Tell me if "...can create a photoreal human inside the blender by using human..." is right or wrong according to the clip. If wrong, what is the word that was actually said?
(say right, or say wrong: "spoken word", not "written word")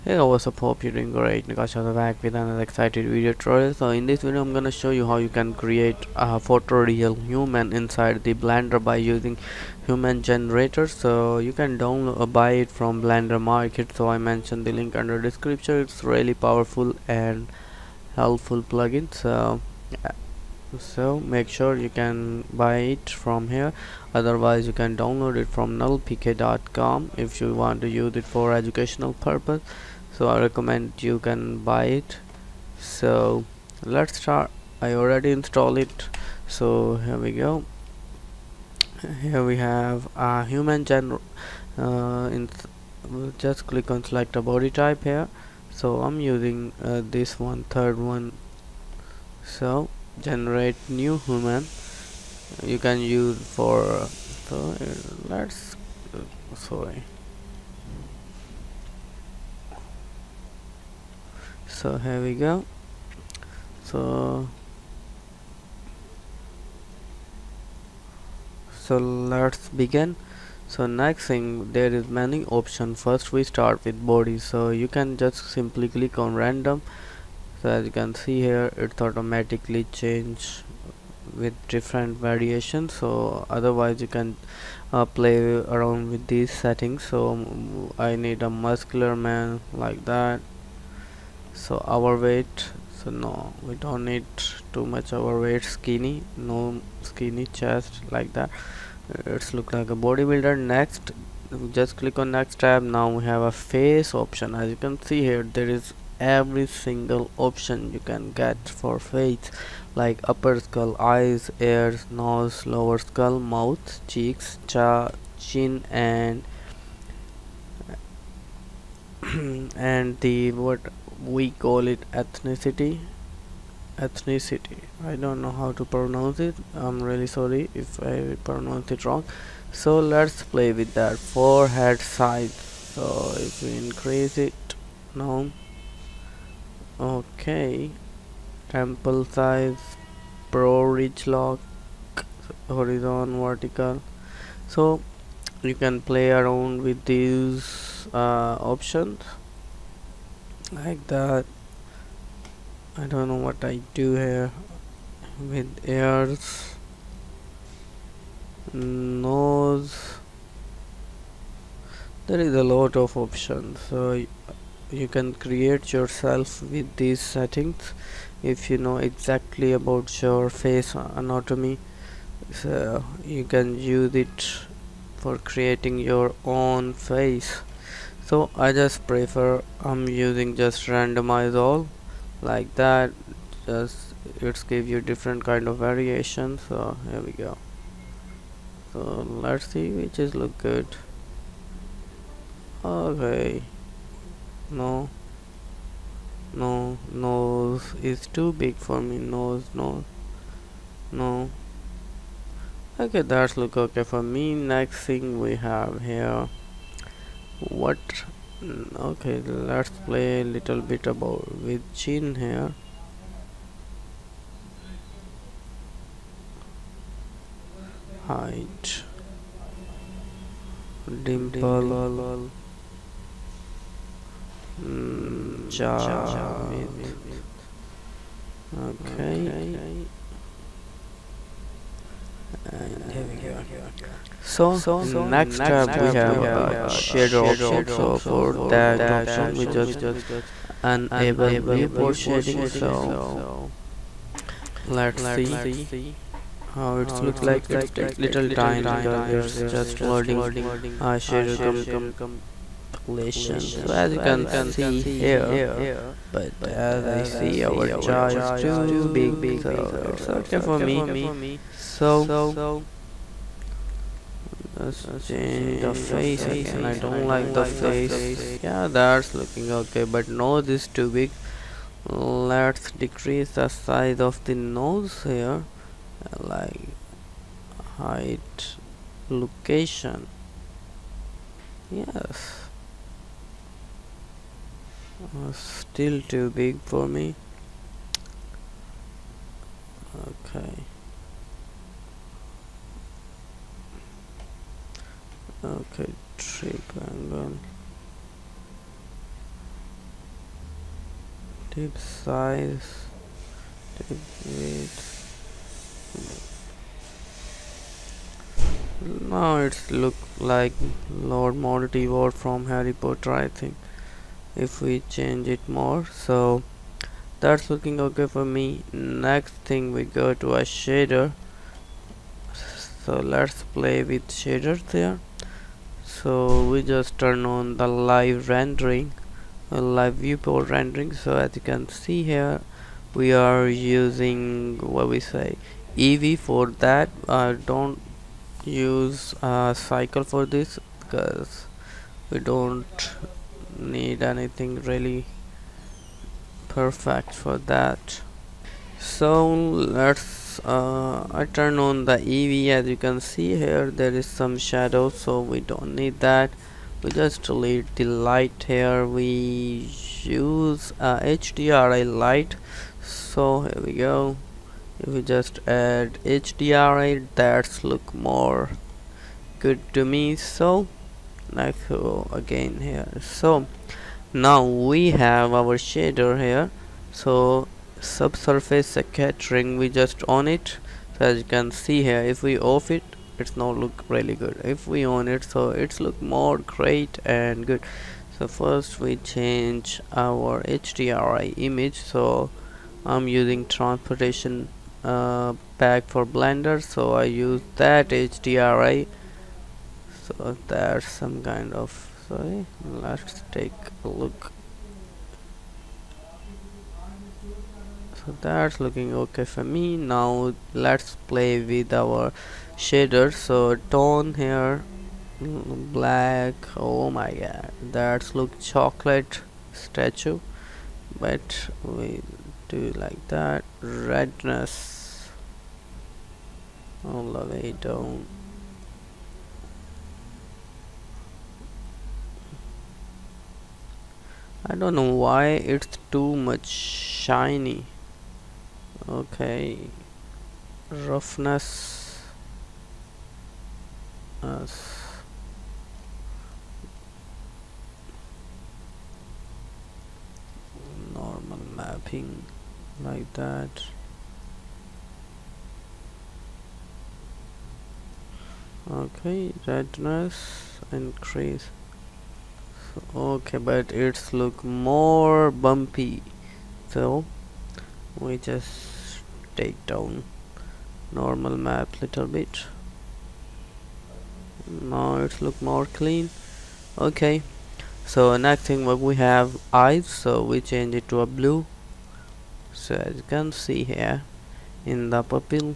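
right.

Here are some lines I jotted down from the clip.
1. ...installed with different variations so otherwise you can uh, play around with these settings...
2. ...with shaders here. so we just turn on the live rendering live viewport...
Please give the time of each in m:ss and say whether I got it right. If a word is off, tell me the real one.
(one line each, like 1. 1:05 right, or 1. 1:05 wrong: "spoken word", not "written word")
1. 1:19 wrong: "changed", not "installed"
2. 5:24 right.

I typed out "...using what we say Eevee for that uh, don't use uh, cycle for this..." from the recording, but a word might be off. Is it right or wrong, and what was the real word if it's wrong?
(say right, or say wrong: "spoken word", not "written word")
right.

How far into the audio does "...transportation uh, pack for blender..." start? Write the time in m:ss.
6:33.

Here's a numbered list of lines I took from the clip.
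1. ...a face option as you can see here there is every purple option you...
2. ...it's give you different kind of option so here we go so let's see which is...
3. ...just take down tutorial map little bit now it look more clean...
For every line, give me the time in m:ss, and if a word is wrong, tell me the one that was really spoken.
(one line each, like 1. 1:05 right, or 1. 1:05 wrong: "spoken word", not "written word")
1. 1:43 wrong: "single", not "purple"
2. 3:04 wrong: "variation", not "option"
3. 7:48 wrong: "normal", not "tutorial".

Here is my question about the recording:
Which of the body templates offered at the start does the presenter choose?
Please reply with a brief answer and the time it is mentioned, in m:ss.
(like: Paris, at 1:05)
Third one, at 0:47.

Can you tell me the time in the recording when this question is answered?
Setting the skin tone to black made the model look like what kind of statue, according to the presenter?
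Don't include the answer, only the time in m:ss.
6:58.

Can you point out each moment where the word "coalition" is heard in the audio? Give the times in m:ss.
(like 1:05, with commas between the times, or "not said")
not said.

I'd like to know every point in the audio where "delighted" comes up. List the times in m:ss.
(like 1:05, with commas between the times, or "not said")
not said.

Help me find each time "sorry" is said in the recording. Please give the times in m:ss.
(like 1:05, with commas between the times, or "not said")
0:56, 2:07, 6:42.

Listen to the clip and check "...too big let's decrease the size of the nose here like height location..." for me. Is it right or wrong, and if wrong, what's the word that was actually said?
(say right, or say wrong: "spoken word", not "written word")
right.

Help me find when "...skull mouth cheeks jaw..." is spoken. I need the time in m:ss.
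1:52.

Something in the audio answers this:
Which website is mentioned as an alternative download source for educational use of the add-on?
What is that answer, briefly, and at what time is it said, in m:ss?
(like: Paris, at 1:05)
nullpk.com, at 0:25.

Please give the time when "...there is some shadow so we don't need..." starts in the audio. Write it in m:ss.
5:53.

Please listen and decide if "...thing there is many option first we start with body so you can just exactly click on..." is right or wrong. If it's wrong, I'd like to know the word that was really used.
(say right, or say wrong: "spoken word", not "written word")
wrong: "simply", not "exactly".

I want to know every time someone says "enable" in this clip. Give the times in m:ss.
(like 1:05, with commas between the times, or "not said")
4:00.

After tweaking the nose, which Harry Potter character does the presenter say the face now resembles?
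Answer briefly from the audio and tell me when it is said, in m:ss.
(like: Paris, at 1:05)
Lord Morty Ward, at 5:11.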